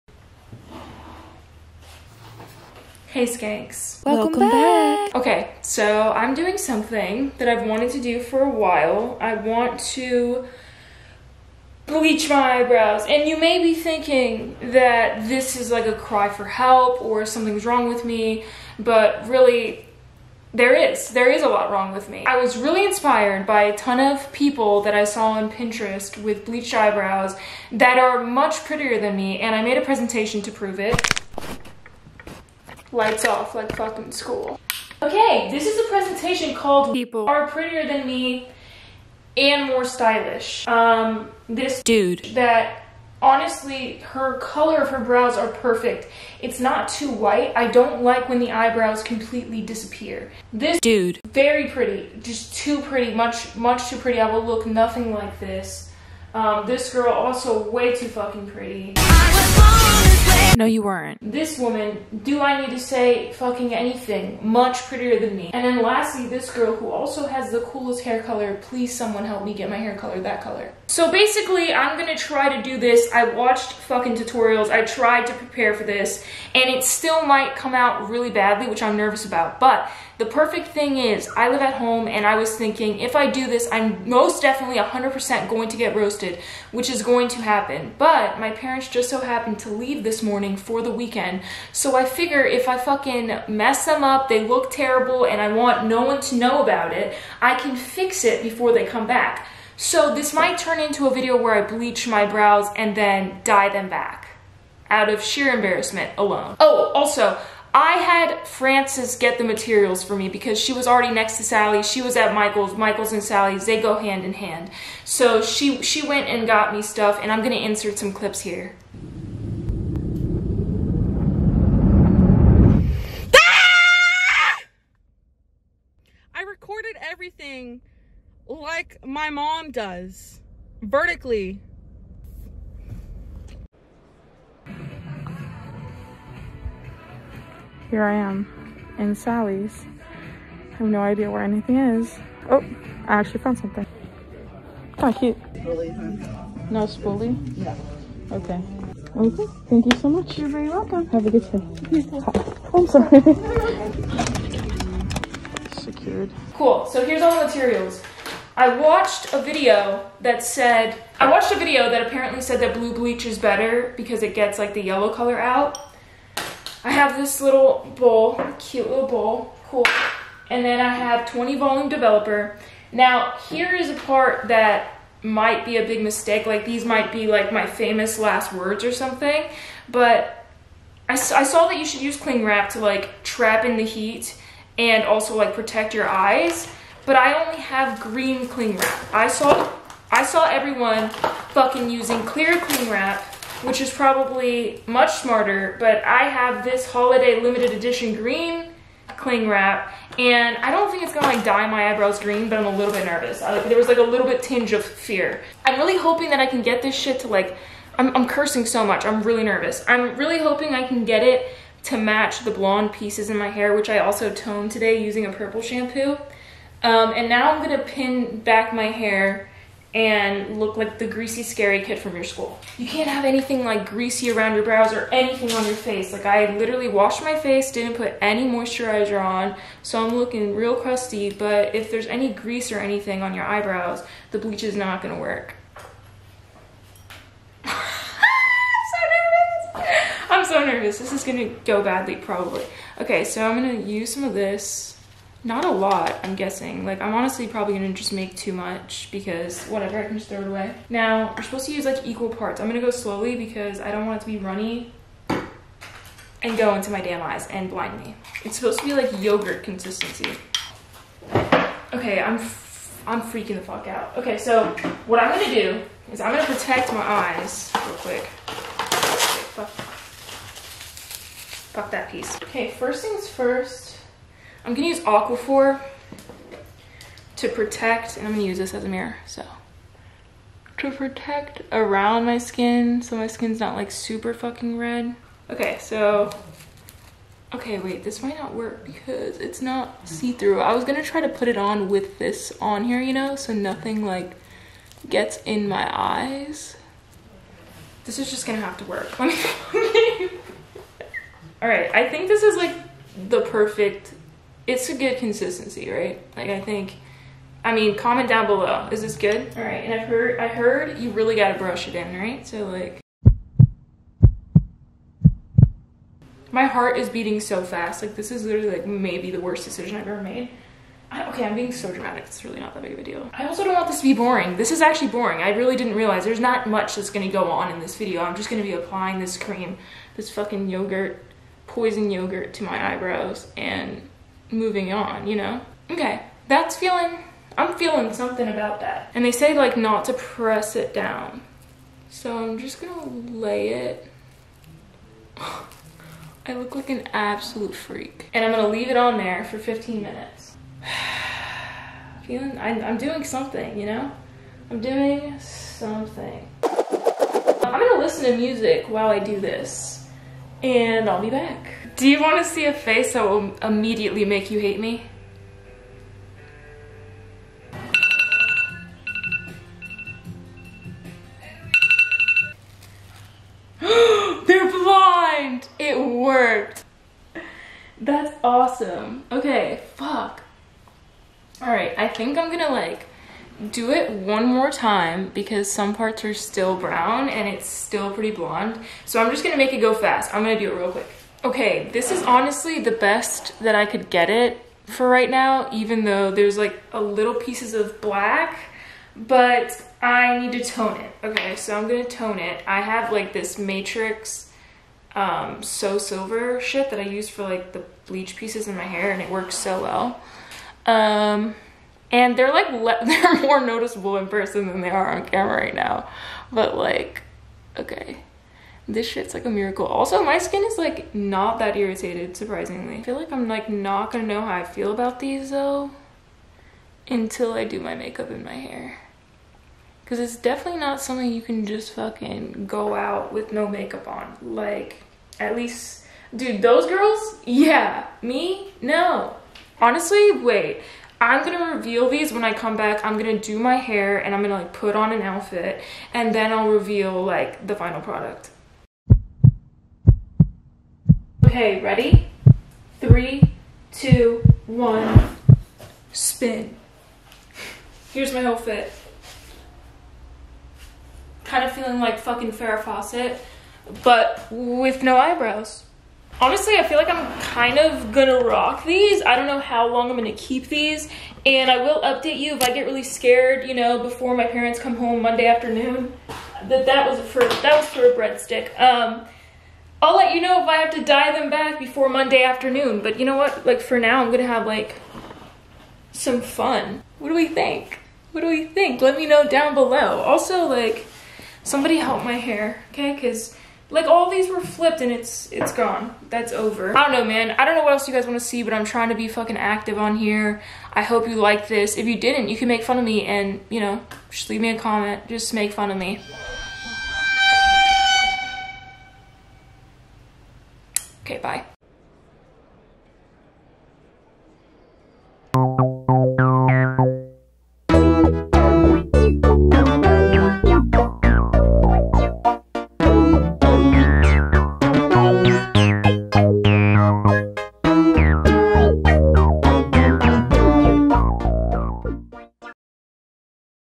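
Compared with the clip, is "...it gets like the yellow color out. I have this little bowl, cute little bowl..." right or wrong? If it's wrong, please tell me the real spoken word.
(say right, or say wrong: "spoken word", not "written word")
right.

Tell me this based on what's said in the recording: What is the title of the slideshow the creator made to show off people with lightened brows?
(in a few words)
People Are Prettier Than Me and More Stylish.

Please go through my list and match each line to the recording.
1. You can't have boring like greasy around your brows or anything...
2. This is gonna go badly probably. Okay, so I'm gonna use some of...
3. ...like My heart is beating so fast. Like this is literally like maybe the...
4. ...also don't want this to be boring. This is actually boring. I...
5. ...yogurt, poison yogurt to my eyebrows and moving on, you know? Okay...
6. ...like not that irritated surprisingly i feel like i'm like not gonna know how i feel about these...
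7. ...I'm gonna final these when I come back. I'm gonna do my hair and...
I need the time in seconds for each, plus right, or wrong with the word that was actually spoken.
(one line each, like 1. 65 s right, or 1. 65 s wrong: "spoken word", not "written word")
1. 222 s wrong: "anything", not "boring"
2. 240 s right
3. 312 s right
4. 323 s right
5. 330 s right
6. 420 s right
7. 441 s wrong: "reveal", not "final".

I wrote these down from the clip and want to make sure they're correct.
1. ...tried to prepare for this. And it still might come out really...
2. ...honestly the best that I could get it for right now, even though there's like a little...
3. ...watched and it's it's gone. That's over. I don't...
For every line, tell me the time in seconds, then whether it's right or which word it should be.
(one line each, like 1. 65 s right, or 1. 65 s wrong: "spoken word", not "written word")
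1. 74 s right
2. 392 s right
3. 494 s wrong: "flipped", not "watched".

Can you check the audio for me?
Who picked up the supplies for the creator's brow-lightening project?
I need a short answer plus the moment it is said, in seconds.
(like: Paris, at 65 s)
Frances, at 108 s.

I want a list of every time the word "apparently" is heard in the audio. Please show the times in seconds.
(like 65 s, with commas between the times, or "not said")
162 s.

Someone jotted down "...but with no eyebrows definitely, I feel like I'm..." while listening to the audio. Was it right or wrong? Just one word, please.
wrong.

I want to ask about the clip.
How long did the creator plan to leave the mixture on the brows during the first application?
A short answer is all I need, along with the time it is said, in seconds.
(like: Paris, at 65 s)
15 minutes, at 349 s.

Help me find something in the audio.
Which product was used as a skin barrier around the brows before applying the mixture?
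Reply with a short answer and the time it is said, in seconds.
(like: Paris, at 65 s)
Aquaphor, at 275 s.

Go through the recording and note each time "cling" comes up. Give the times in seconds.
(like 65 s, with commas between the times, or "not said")
182 s, 188 s, 192 s, 199 s.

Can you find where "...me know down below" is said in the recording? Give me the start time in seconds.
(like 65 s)
489 s.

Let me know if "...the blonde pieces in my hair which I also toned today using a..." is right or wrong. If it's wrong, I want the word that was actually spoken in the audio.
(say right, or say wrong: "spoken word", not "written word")
right.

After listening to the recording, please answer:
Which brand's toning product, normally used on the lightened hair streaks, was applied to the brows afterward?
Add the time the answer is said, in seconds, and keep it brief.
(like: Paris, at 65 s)
Matrix, at 403 s.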